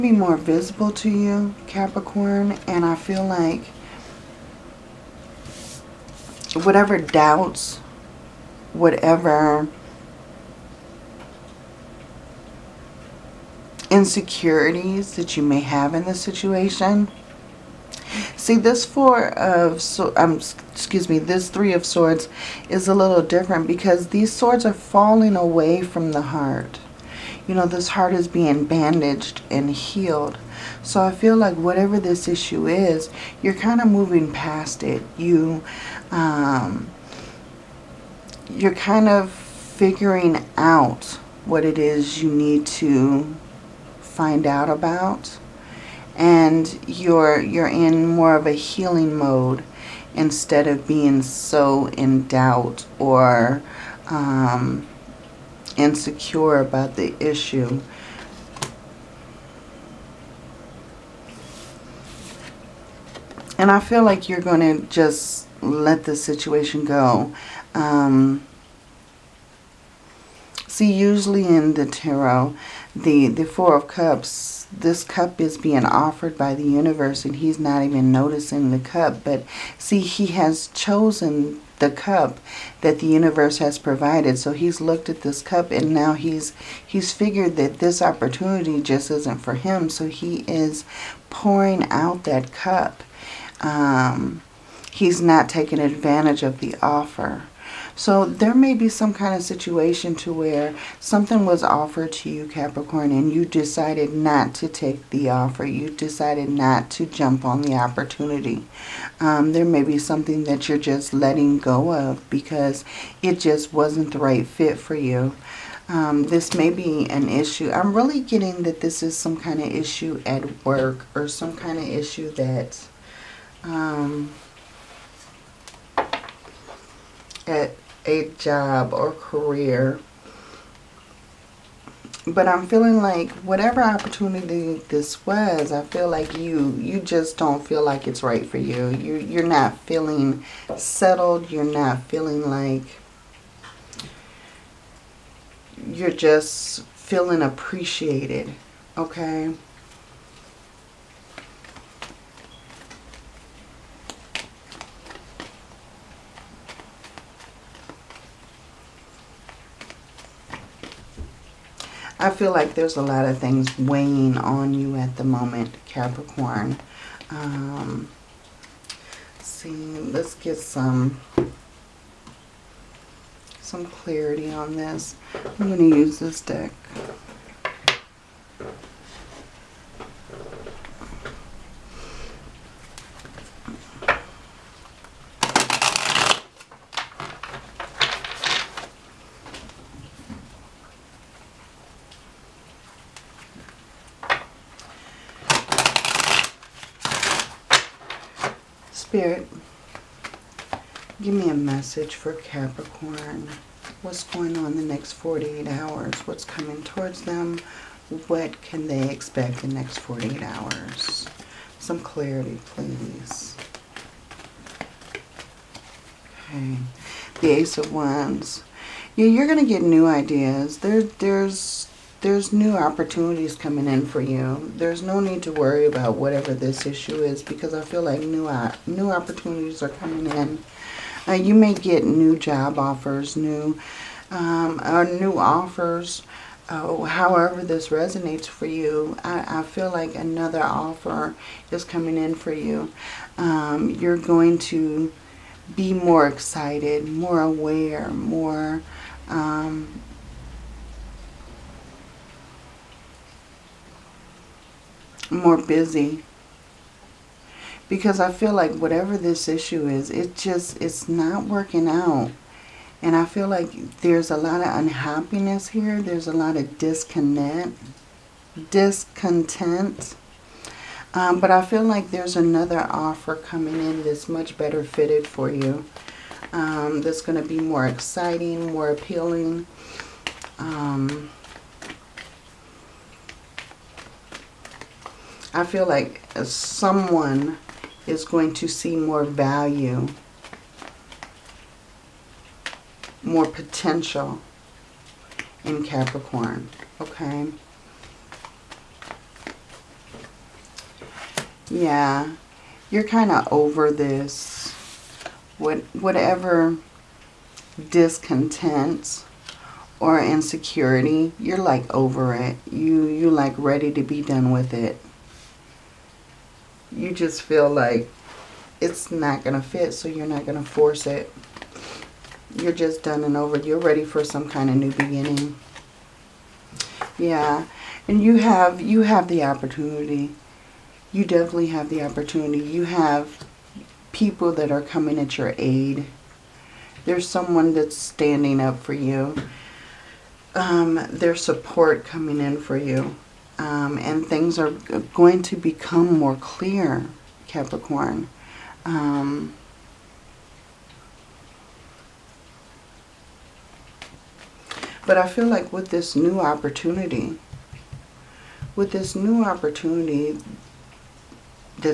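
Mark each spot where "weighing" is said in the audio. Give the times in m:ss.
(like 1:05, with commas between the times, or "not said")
2:43.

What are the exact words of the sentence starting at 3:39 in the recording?
Yeah, you're going to get new ideas.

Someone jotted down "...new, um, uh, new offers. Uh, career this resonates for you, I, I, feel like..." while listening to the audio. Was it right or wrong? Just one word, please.
wrong.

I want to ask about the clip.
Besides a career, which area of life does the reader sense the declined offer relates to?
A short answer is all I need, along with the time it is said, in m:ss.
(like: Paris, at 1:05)
work, at 2:00.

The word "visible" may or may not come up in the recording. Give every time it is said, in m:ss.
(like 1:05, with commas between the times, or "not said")
0:00.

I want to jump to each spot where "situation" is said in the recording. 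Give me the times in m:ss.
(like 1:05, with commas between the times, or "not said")
0:16, 1:06, 1:39.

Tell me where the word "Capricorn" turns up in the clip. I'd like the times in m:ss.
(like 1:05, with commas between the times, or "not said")
0:01, 1:42, 2:45, 3:22, 4:55, 5:47.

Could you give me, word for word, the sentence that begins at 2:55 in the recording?
I'm going to use this deck.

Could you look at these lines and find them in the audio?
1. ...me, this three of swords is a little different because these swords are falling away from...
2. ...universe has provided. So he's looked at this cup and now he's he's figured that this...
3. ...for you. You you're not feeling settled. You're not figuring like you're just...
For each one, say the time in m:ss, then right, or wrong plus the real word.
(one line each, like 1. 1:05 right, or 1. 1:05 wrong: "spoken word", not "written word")
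1. 0:21 right
2. 1:23 right
3. 2:18 wrong: "feeling", not "figuring".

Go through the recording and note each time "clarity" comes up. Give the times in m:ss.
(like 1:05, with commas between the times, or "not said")
2:53, 3:32.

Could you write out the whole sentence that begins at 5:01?
Yeah, you're kind of over this, what, whatever discontent or insecurity, you're like over it.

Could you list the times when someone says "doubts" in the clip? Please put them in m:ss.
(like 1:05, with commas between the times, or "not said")
0:06, 0:52.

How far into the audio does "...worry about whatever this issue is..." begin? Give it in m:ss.
3:45.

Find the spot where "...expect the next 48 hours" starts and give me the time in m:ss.
3:29.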